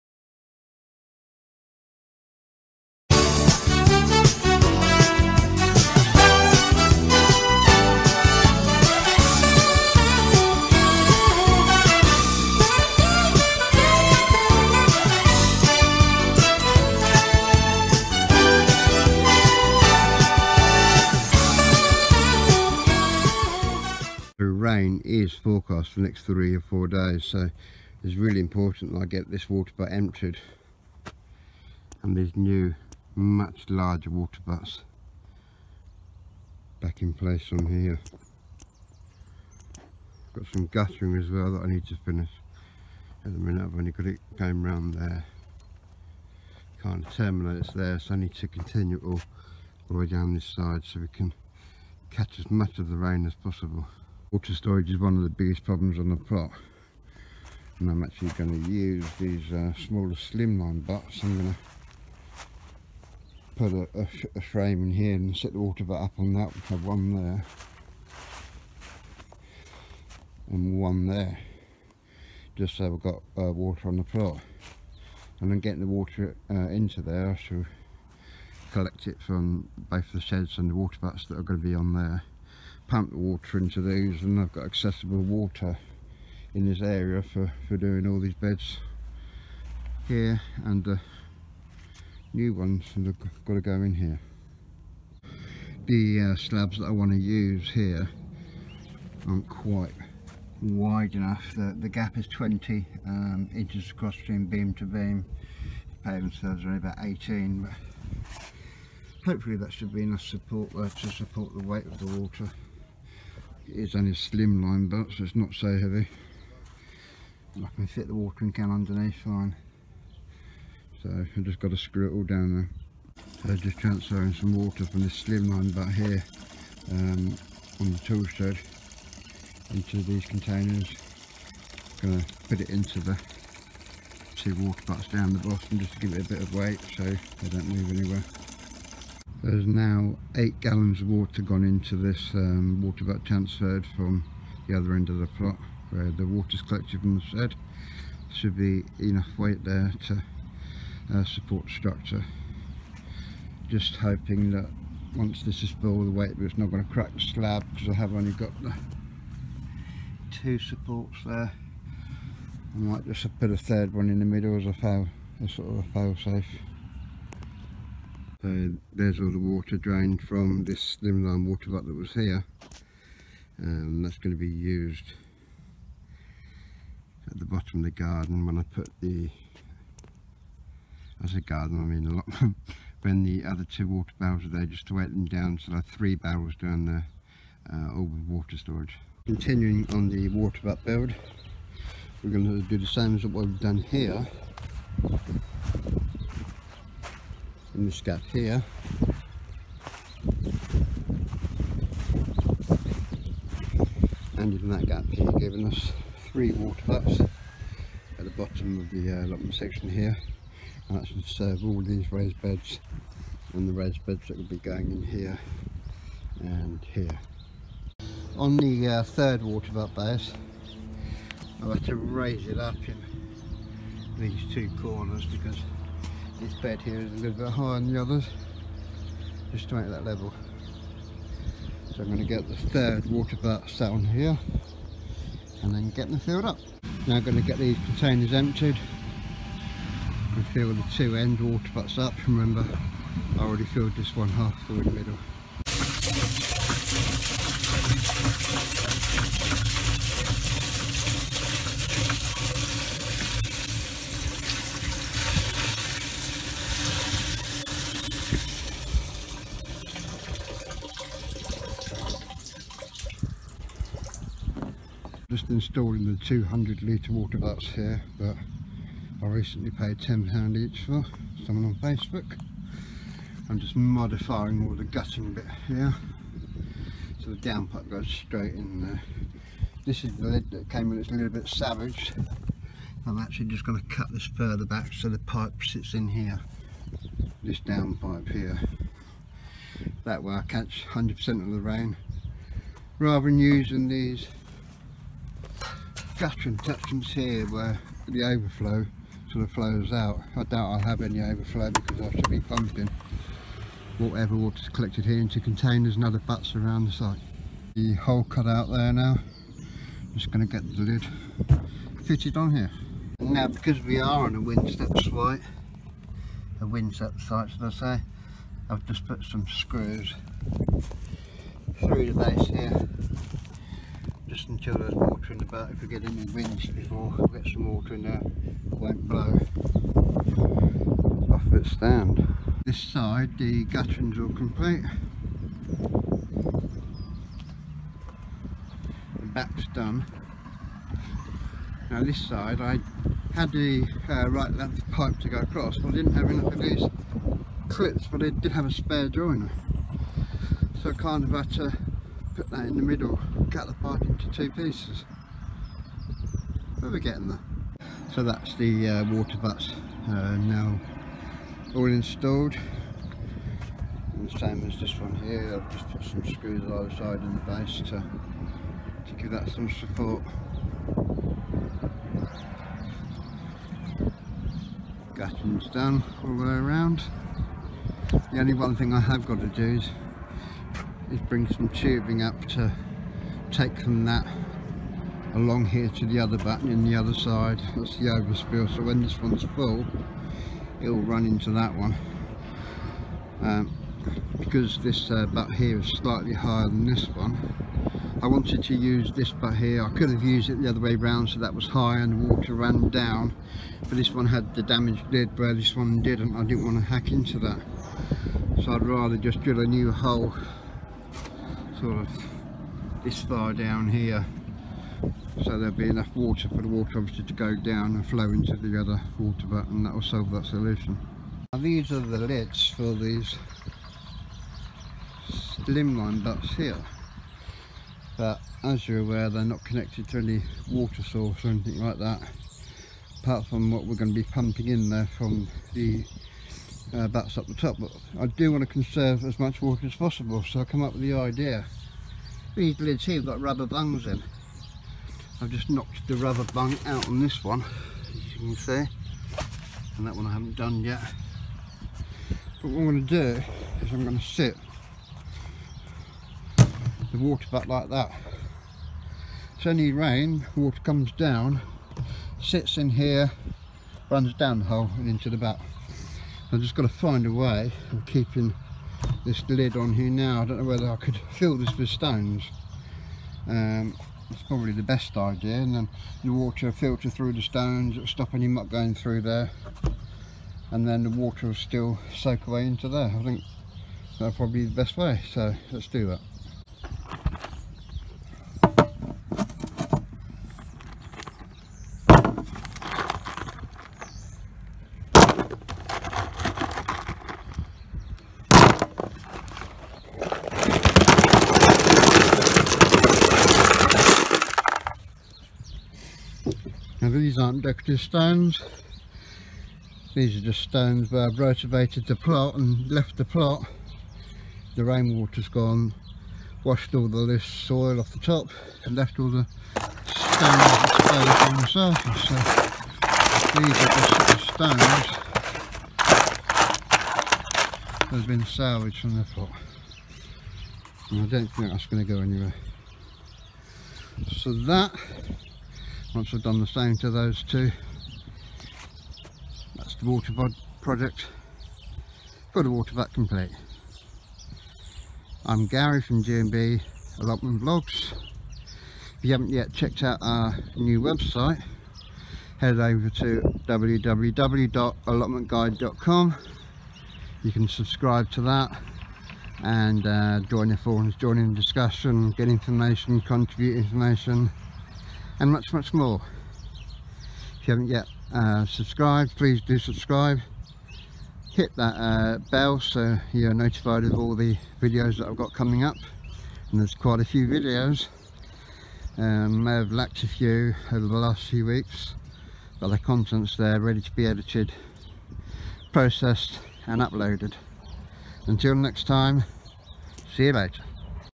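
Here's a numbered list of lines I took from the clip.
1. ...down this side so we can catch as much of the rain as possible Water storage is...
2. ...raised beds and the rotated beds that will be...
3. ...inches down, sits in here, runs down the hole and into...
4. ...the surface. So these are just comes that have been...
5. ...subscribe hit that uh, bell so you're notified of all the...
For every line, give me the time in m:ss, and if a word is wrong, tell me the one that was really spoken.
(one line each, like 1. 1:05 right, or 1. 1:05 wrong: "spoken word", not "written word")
1. 0:50 right
2. 3:32 wrong: "raised", not "rotated"
3. 7:40 wrong: "comes", not "inches"
4. 8:41 wrong: "stones", not "comes"
5. 9:29 right.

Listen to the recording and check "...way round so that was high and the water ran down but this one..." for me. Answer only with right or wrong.
right.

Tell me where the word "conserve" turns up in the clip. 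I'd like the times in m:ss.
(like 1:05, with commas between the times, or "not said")
7:18.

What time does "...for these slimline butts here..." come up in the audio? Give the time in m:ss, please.
7:02.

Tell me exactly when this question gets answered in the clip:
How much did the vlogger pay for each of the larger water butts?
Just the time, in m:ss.
4:29.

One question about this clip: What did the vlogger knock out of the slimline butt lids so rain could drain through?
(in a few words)
Rubber bungs.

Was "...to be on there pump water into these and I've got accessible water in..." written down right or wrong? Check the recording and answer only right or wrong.
right.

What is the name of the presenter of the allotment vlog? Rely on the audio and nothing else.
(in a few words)
Gary.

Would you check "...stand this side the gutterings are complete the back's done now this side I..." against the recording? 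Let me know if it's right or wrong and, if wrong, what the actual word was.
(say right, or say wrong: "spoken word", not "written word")
right.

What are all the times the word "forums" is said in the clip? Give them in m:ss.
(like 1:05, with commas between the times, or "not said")
9:20.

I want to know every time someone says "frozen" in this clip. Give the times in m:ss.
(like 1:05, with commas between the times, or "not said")
not said.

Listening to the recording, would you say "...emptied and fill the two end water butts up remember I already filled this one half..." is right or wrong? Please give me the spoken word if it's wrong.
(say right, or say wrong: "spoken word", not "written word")
right.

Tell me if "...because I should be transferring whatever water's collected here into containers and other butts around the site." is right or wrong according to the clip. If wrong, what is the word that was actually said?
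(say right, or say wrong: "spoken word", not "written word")
wrong: "pumping", not "transferring".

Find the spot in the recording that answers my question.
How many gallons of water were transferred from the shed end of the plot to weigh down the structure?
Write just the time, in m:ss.
2:20.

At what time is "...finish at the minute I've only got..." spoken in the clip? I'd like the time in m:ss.
0:42.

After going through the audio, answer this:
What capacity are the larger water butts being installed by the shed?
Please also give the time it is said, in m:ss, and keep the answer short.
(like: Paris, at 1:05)
200 litres, at 4:26.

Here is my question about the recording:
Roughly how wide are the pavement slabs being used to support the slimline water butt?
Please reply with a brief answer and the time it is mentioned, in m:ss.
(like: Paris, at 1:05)
18 inches, at 1:46.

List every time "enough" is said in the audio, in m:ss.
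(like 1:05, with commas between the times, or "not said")
1:41, 1:50, 2:28, 5:46, 6:55.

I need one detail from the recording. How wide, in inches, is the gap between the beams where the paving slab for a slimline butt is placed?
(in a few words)
20 inches.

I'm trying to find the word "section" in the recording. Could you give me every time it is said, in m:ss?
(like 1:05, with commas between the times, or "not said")
3:29, 4:56.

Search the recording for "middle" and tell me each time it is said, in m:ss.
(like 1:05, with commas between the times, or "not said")
2:44, 4:04, 5:52.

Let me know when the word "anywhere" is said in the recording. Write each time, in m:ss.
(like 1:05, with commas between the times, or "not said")
2:17, 8:52.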